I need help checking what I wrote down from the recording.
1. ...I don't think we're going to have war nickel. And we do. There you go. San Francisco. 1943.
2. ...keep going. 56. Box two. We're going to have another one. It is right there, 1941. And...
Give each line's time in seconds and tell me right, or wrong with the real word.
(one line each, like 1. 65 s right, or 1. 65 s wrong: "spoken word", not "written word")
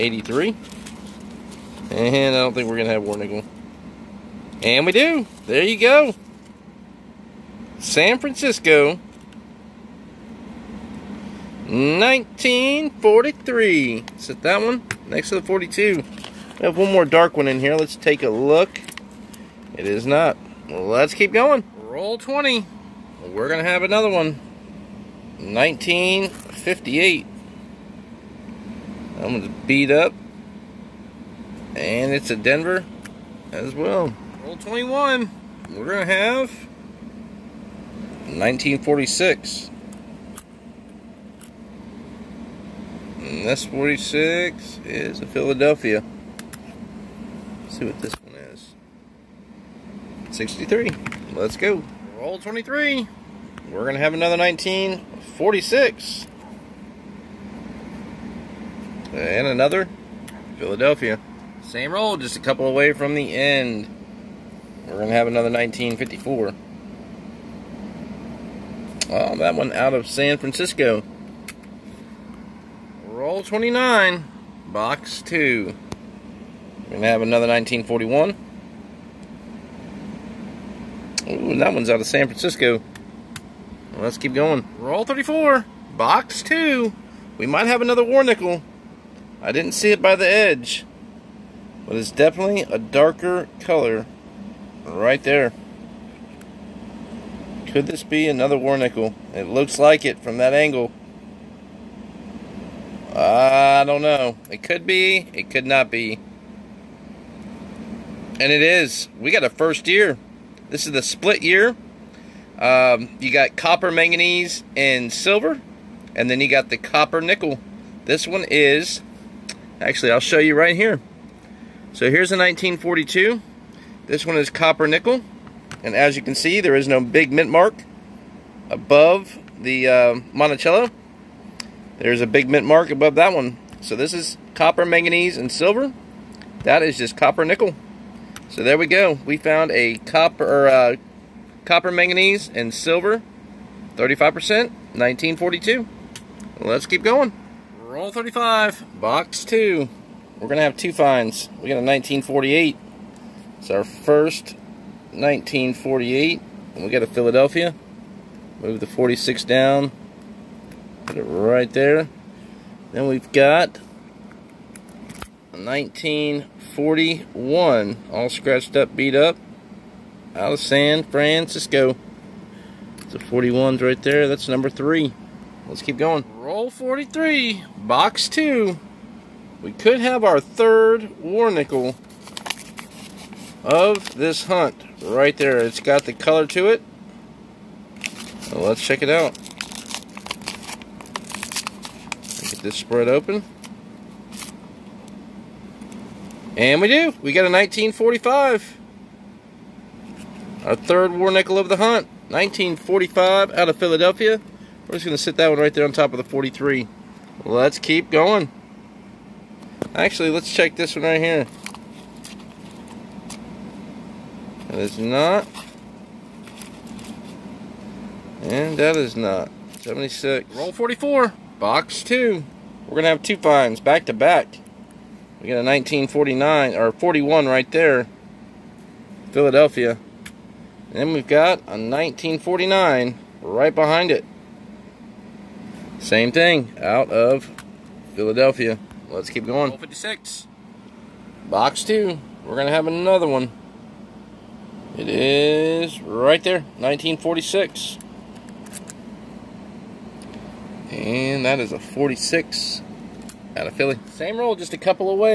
1. 2 s right
2. 239 s wrong: "1946", not "1941".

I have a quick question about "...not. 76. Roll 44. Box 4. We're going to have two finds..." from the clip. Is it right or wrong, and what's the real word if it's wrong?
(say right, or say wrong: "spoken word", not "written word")
wrong: "2", not "4".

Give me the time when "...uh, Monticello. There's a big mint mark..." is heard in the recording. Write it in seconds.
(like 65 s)
129 s.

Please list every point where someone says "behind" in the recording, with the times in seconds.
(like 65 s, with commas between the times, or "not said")
233 s.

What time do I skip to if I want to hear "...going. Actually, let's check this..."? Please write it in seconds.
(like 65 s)
208 s.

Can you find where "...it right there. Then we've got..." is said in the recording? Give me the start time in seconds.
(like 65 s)
161 s.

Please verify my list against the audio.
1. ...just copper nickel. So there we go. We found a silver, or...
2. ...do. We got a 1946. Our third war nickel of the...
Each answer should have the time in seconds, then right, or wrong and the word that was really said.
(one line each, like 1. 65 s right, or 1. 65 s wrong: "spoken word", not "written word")
1. 136 s wrong: "copper", not "silver"
2. 196 s wrong: "1945", not "1946".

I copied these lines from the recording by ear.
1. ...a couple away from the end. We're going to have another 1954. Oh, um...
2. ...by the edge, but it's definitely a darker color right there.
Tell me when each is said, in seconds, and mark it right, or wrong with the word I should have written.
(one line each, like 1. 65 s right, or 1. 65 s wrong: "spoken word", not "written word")
1. 62 s right
2. 90 s right.